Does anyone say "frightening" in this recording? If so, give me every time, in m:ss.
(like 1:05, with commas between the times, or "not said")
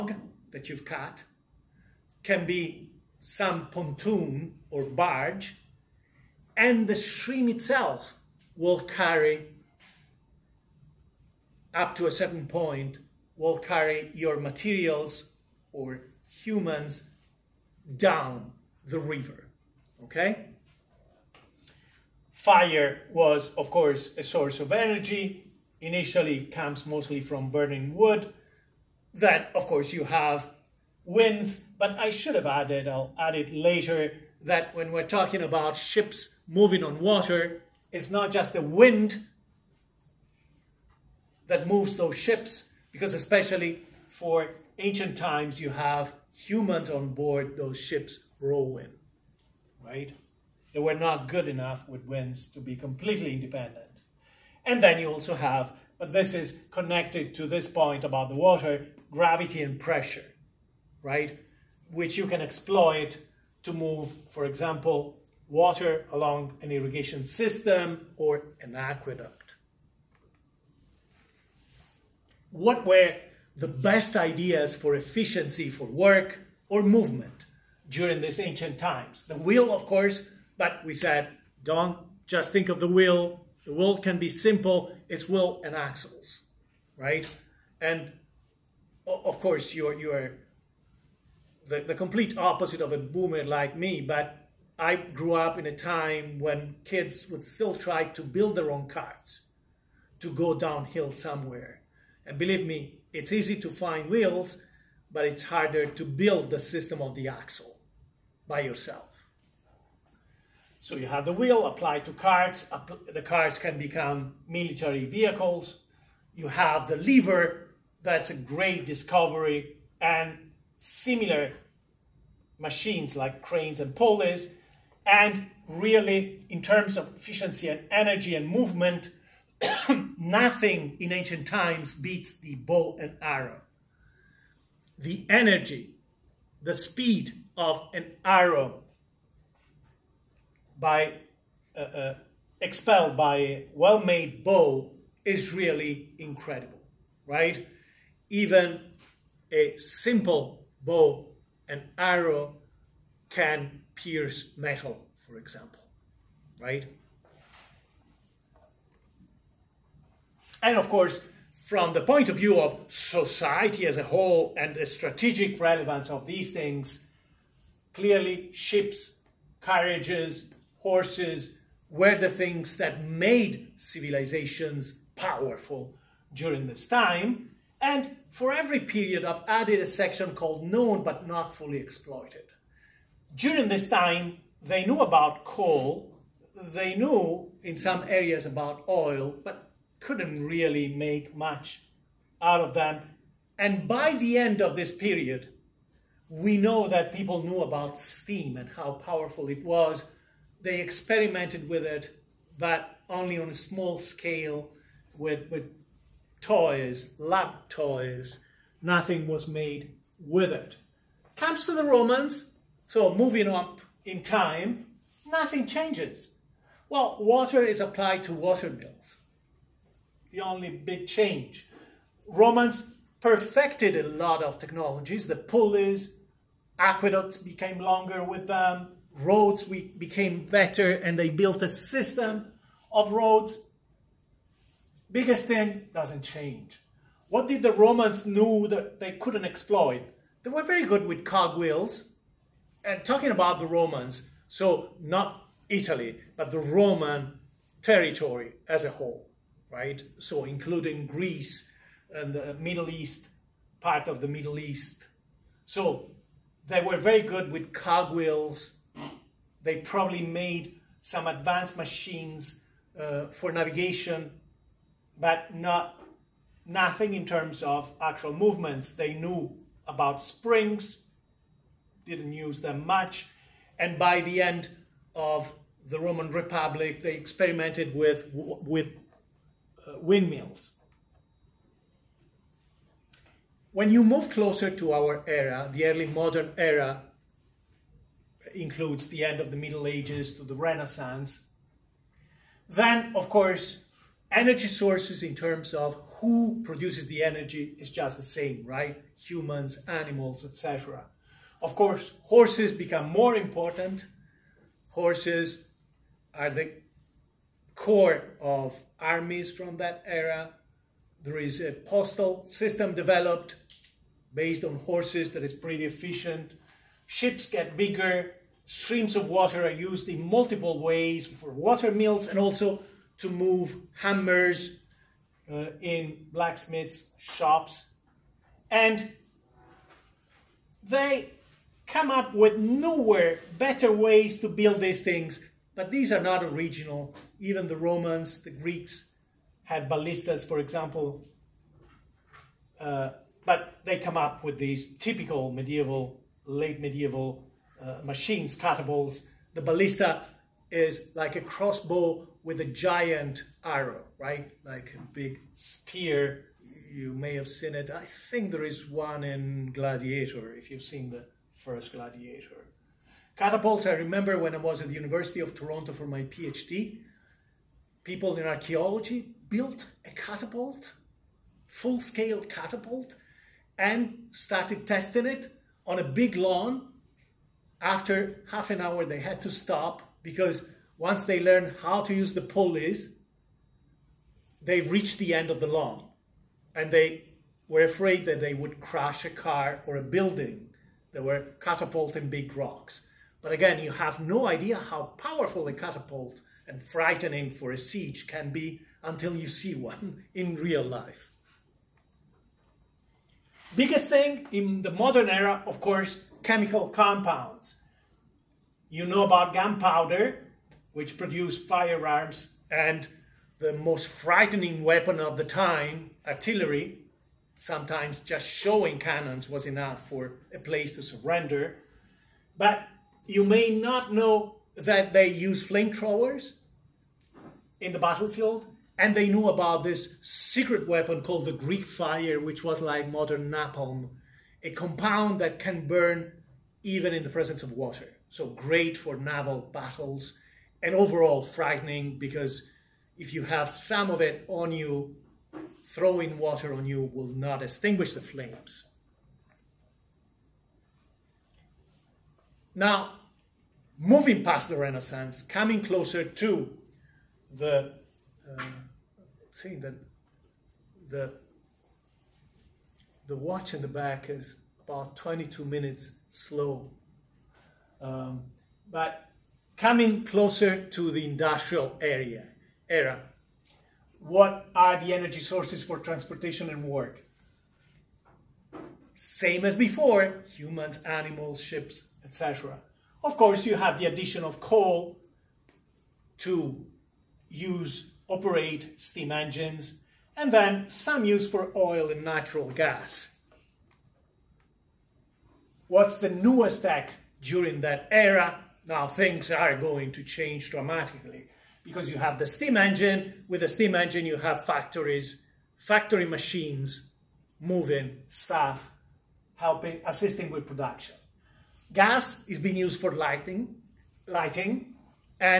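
6:36, 6:54, 7:21.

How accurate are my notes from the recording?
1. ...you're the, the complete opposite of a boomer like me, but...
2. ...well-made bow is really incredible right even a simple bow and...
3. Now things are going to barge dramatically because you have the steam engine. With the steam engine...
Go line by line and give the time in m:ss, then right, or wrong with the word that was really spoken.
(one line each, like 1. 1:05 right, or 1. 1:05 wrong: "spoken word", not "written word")
1. 1:29 right
2. 2:23 right
3. 8:18 wrong: "change", not "barge".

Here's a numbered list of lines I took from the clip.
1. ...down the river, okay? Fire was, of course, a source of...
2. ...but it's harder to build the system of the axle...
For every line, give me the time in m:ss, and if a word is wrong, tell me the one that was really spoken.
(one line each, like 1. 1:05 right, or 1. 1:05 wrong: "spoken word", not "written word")
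1. 0:17 right
2. 1:45 right.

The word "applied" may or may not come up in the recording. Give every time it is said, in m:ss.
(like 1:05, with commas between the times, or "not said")
1:51, 3:37.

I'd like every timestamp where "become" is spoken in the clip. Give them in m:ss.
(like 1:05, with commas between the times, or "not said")
1:53, 5:02.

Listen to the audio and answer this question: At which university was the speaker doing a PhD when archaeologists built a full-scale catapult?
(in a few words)
University of Toronto.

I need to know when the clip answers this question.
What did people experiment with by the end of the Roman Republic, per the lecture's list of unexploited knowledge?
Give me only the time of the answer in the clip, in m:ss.
4:39.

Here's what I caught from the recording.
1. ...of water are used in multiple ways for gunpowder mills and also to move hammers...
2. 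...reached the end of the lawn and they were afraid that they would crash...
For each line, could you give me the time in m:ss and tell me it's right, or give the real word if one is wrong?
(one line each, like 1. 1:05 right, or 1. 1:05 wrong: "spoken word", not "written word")
1. 5:19 wrong: "water", not "gunpowder"
2. 6:24 right.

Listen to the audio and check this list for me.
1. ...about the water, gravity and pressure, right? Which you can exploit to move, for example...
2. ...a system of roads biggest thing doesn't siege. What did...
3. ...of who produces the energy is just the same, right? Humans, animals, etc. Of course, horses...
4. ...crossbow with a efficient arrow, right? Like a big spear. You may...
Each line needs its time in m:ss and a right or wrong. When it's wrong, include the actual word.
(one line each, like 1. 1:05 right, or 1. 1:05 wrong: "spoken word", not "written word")
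1. 0:58 right
2. 3:51 wrong: "change", not "siege"
3. 4:55 right
4. 5:51 wrong: "giant", not "efficient".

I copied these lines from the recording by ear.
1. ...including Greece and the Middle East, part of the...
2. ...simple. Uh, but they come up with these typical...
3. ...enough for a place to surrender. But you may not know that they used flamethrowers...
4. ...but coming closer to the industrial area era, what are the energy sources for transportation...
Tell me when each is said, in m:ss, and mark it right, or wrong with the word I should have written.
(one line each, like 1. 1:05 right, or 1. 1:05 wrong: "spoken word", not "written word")
1. 4:10 right
2. 5:40 wrong: "example", not "simple"
3. 6:59 right
4. 7:48 right.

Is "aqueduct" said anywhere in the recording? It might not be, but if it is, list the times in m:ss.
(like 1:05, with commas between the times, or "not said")
1:08, 3:46.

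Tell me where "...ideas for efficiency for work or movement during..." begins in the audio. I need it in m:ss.
1:14.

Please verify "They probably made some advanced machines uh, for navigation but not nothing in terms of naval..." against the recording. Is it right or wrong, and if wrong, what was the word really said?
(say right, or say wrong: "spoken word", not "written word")
wrong: "actual", not "naval".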